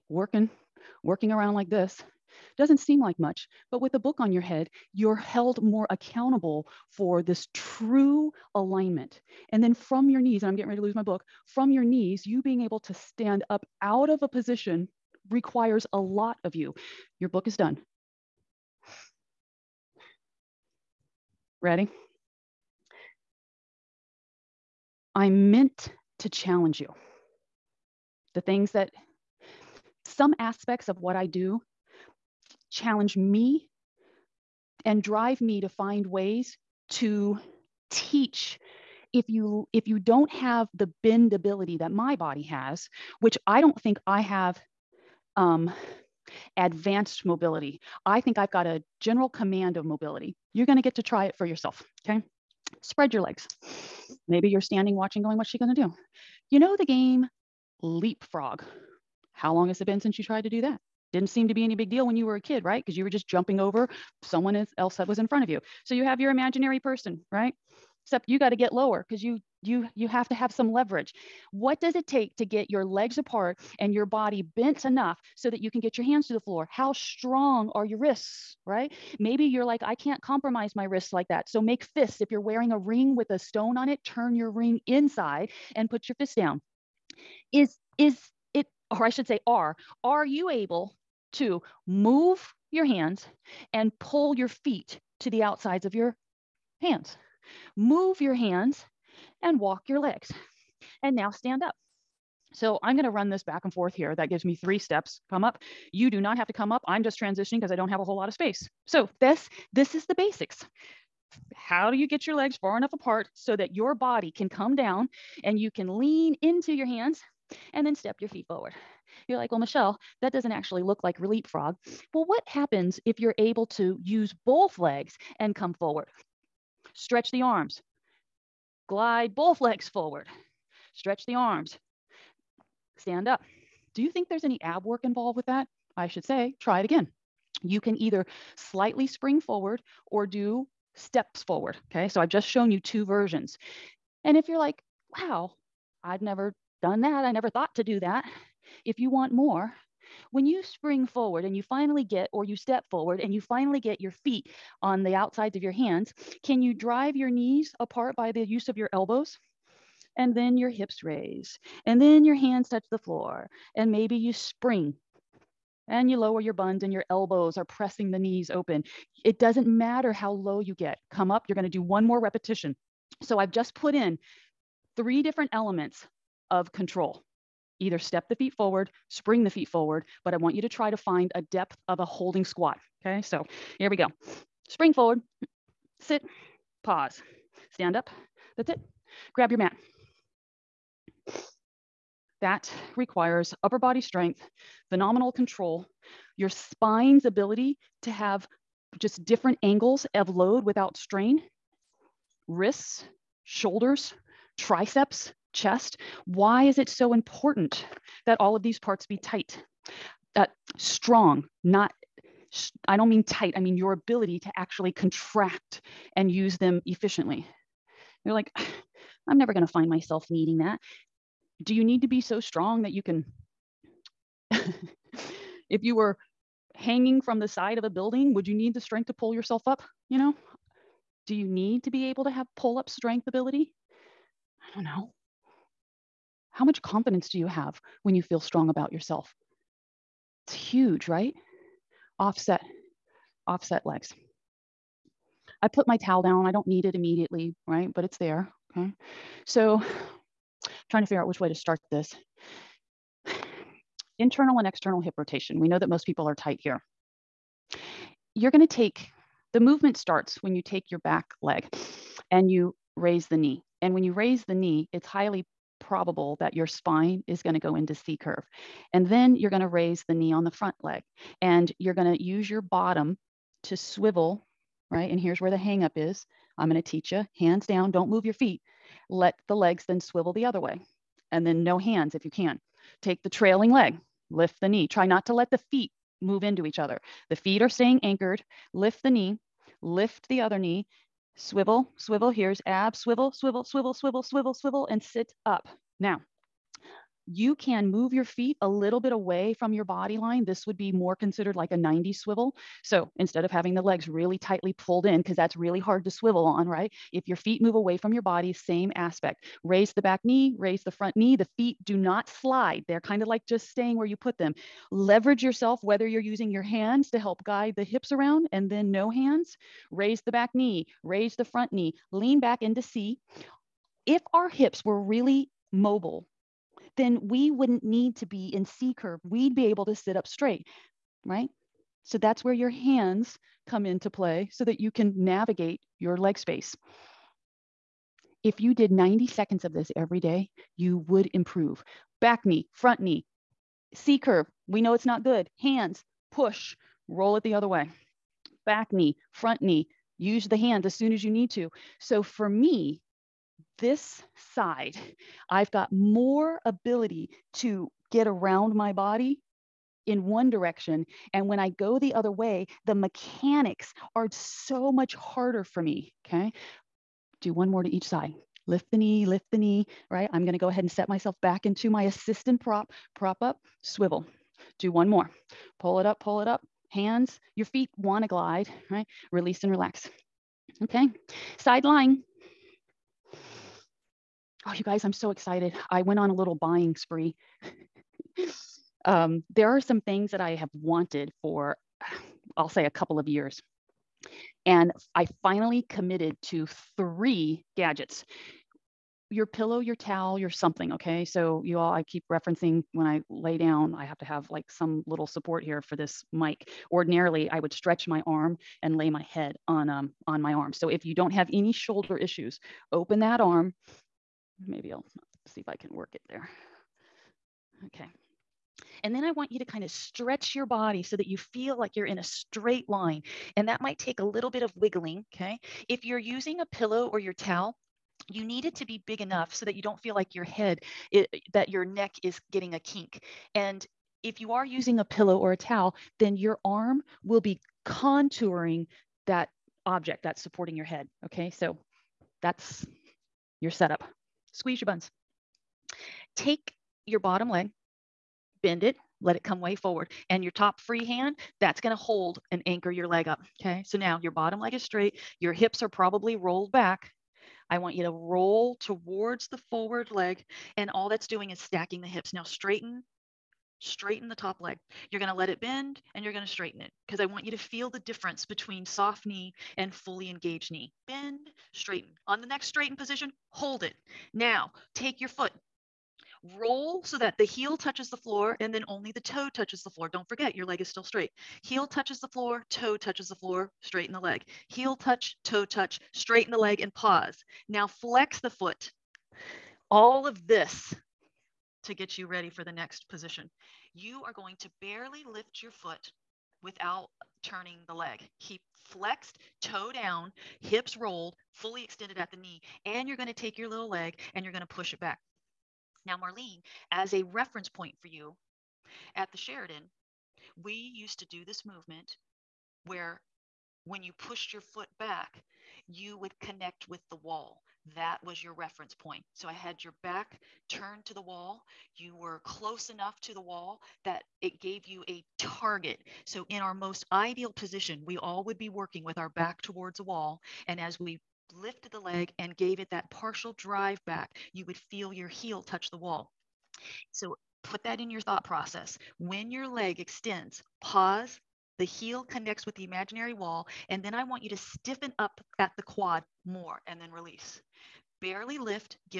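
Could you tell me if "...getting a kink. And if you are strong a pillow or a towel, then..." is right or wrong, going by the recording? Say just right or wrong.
wrong.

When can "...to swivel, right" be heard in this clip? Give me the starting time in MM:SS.
04:33.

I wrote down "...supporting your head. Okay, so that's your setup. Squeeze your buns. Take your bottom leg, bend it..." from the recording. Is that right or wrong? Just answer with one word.
right.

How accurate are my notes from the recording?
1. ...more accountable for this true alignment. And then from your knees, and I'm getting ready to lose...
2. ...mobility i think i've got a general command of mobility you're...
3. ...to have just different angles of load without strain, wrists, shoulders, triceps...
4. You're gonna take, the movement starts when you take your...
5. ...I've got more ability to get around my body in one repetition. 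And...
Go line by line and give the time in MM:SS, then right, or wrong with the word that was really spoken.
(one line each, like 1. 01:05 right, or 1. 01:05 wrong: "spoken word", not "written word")
1. 00:05 right
2. 00:47 right
3. 03:18 right
4. 04:18 right
5. 05:55 wrong: "direction", not "repetition".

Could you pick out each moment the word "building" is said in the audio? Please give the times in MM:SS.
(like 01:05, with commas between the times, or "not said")
03:47.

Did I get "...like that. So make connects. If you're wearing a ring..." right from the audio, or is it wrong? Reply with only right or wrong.
wrong.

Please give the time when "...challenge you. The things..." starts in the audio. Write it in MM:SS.
00:26.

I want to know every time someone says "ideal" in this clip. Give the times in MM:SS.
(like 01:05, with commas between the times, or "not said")
08:47.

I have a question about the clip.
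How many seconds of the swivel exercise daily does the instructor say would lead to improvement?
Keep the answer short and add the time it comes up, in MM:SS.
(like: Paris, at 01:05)
90, at 05:38.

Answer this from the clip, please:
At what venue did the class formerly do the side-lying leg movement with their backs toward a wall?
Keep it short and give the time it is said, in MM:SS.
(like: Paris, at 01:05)
The Sheridan, at 08:29.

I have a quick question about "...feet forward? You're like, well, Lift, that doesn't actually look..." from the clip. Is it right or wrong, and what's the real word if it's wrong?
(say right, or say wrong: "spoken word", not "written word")
wrong: "Michelle", not "Lift".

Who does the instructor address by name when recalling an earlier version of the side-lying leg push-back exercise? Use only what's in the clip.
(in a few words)
Marlene.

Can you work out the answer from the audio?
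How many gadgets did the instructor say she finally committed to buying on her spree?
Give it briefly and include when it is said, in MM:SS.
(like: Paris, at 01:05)
3, at 06:36.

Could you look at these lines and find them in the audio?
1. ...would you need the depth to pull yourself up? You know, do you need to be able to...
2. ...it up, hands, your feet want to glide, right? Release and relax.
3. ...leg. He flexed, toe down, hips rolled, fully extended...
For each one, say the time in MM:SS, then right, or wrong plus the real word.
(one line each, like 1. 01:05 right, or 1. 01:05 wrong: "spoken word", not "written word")
1. 03:48 wrong: "strength", not "depth"
2. 06:16 right
3. 08:17 right.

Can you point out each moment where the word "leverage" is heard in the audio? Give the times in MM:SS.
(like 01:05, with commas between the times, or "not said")
01:10, 05:14.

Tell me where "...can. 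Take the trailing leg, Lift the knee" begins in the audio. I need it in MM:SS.
04:42.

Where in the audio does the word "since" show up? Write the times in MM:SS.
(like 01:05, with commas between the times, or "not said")
01:00.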